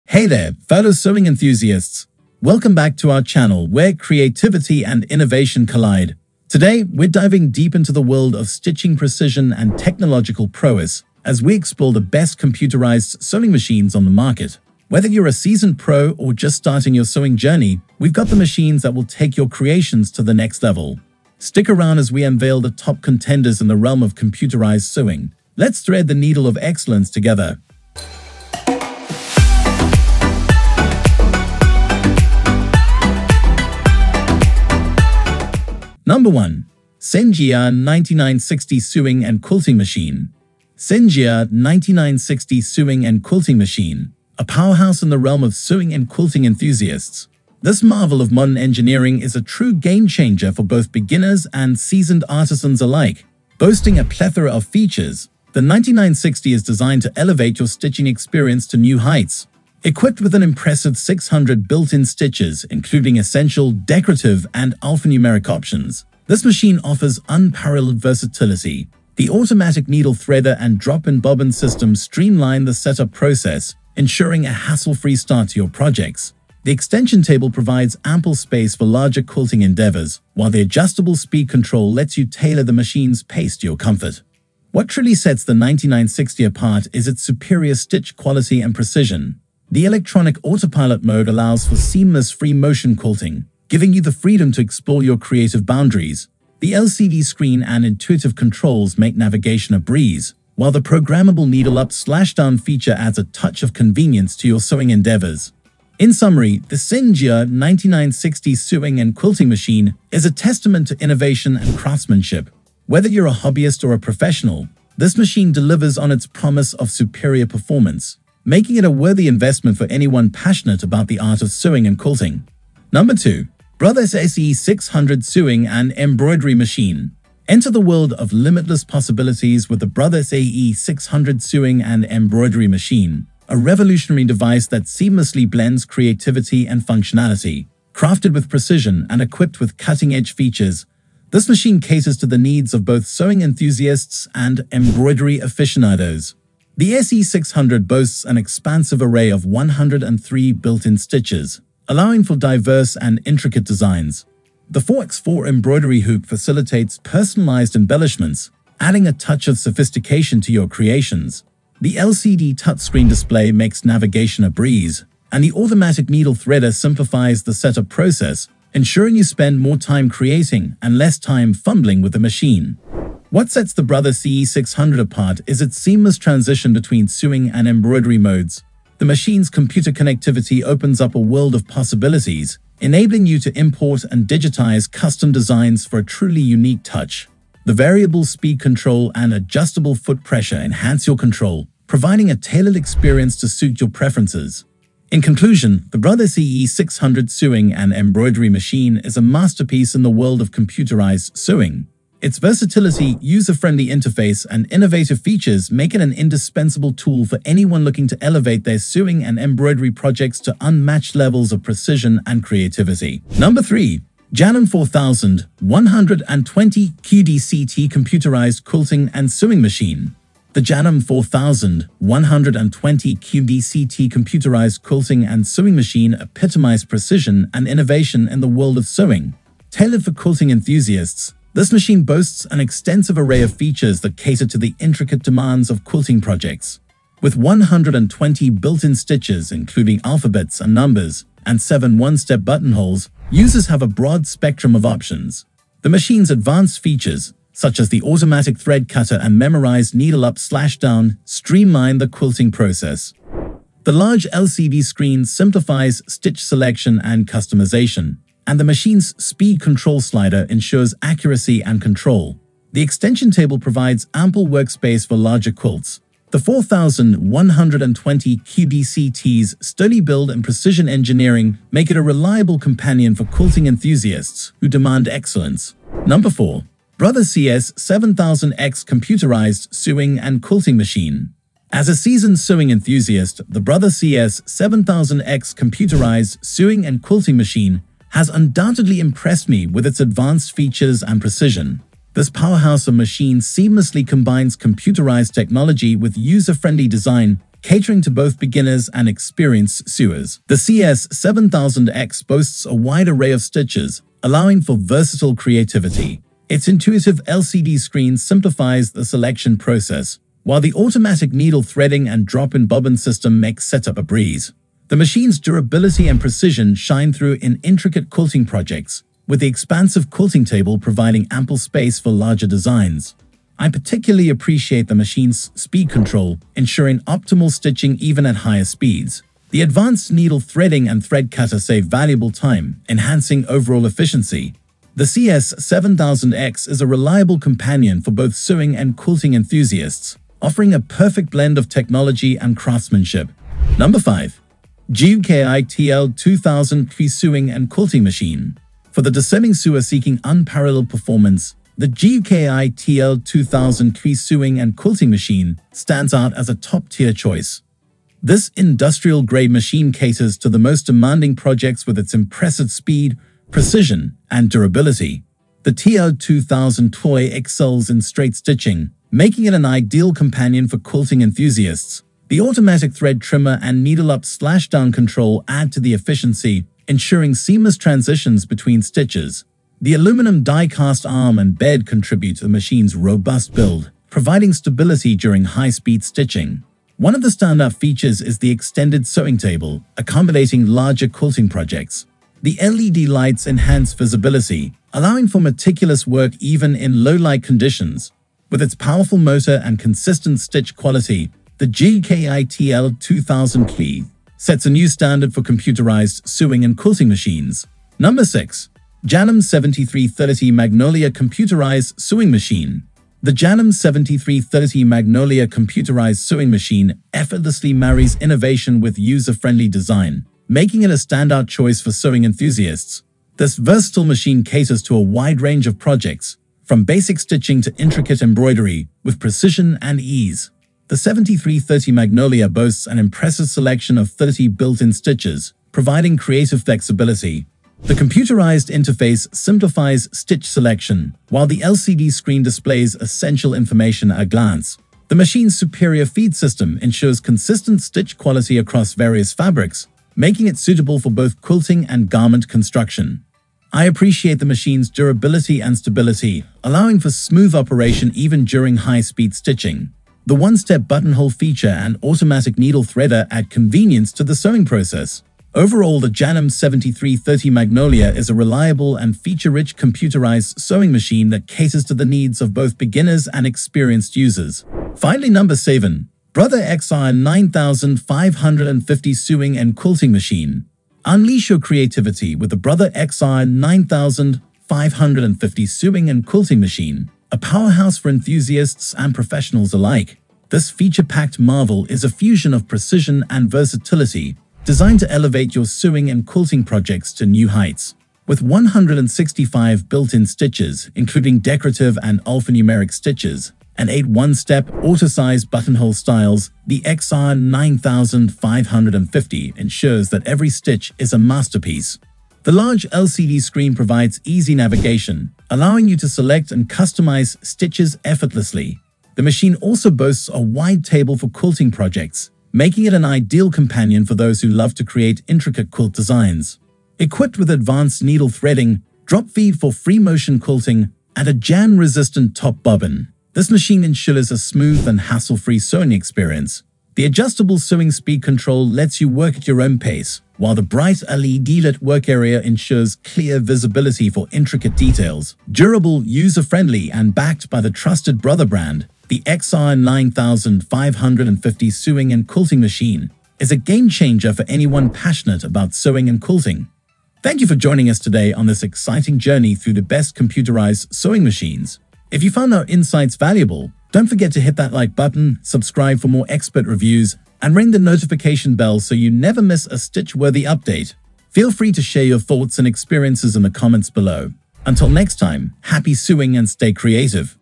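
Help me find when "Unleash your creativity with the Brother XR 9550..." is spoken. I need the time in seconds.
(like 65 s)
481 s.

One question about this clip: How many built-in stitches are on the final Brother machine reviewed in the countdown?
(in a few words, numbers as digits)
165.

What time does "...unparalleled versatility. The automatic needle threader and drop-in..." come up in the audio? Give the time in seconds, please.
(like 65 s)
67 s.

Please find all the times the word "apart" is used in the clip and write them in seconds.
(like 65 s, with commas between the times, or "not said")
86 s, 174 s.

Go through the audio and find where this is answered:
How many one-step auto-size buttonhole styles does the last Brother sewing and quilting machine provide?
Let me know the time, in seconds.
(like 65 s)
503 s.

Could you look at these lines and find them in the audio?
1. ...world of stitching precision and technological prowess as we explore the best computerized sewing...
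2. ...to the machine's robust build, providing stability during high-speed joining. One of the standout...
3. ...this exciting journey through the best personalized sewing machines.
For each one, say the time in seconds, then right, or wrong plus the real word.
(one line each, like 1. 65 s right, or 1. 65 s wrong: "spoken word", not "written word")
1. 8 s right
2. 382 s wrong: "stitching", not "joining"
3. 558 s wrong: "computerized", not "personalized".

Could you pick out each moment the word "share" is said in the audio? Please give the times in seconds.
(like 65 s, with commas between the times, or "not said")
571 s.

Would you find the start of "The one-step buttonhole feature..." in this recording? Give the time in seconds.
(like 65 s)
460 s.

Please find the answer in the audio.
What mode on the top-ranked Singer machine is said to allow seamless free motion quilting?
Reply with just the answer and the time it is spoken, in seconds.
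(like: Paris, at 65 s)
electronic autopilot mode, at 89 s.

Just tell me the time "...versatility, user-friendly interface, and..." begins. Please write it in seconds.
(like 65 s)
202 s.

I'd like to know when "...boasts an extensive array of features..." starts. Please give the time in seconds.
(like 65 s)
232 s.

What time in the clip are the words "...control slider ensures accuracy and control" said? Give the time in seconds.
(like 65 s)
259 s.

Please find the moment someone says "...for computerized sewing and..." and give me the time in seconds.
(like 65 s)
405 s.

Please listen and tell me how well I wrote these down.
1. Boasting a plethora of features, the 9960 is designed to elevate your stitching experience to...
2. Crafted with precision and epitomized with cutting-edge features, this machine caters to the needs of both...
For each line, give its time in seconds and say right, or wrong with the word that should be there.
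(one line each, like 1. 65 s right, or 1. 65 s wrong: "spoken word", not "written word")
1. 53 s right
2. 137 s wrong: "equipped", not "epitomized".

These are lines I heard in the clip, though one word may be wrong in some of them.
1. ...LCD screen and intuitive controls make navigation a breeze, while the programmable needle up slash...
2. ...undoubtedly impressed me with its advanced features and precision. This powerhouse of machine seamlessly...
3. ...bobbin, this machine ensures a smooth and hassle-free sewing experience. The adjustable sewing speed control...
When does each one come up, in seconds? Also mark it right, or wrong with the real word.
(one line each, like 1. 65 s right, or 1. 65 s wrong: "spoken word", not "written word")
1. 96 s right
2. 288 s right
3. 532 s right.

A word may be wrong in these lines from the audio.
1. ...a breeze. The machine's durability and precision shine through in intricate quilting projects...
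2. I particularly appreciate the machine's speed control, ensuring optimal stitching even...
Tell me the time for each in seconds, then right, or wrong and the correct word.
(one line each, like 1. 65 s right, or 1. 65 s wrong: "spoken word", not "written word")
1. 313 s right
2. 323 s right.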